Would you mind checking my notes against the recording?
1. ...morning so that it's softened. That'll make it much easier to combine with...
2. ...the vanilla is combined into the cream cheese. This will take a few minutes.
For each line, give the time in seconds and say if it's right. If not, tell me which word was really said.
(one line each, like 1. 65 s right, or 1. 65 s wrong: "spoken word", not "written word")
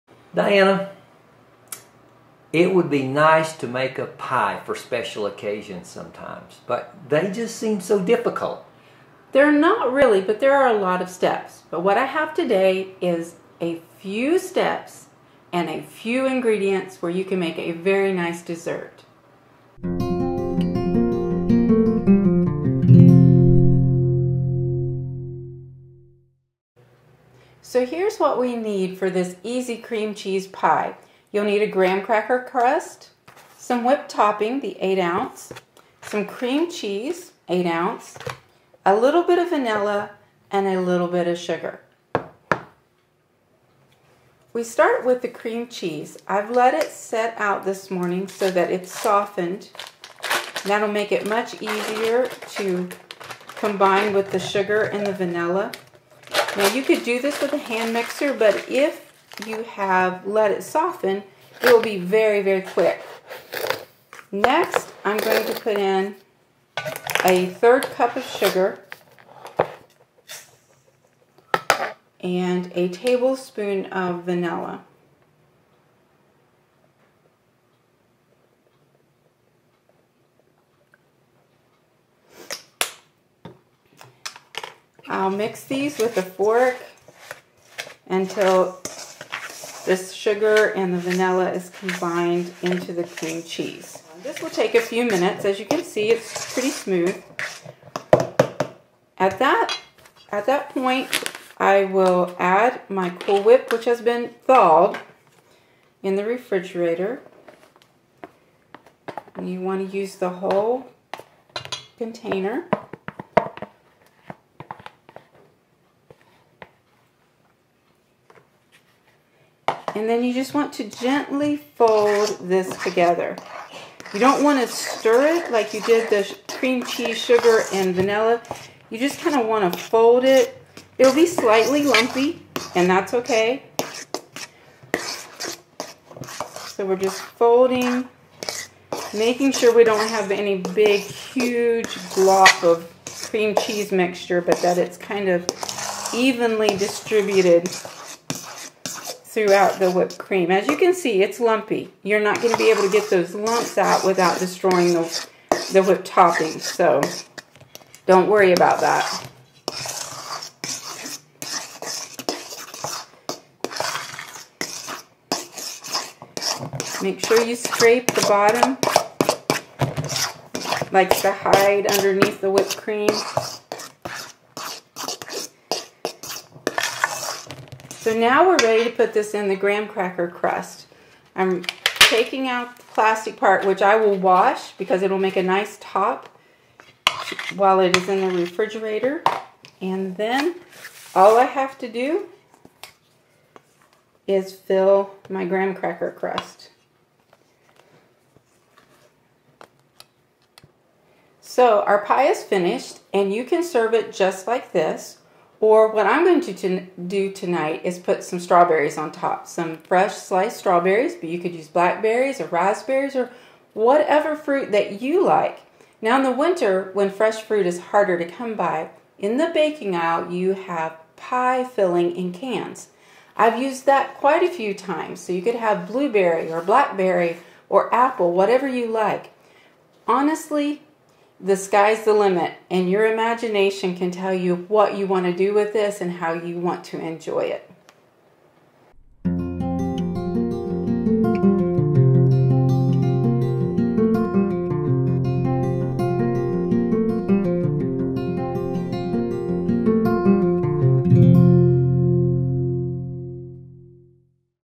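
1. 47 s right
2. 90 s right.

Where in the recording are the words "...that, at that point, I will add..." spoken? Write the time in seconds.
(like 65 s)
99 s.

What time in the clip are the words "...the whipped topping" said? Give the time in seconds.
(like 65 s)
155 s.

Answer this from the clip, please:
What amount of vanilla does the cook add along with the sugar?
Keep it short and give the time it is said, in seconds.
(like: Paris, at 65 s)
1 tablespoon, at 72 s.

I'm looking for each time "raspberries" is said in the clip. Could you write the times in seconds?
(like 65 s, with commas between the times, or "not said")
212 s.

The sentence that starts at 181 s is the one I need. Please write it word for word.
I'm taking out the plastic part, which I will wash because it'll make a nice top while it is in the refrigerator.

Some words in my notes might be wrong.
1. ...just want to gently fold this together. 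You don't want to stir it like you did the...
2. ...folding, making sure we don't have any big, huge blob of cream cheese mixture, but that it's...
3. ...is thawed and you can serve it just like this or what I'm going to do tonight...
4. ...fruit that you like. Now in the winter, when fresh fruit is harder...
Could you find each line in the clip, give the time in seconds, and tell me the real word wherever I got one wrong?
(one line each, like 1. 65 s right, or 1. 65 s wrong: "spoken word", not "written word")
1. 120 s right
2. 137 s right
3. 202 s wrong: "finished", not "thawed"
4. 214 s right.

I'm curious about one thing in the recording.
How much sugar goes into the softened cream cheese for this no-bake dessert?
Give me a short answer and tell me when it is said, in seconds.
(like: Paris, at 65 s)
1/3 cup, at 67 s.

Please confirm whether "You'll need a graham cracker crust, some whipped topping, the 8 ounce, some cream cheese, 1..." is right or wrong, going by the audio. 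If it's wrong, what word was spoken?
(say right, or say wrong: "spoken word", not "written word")
wrong: "8", not "1".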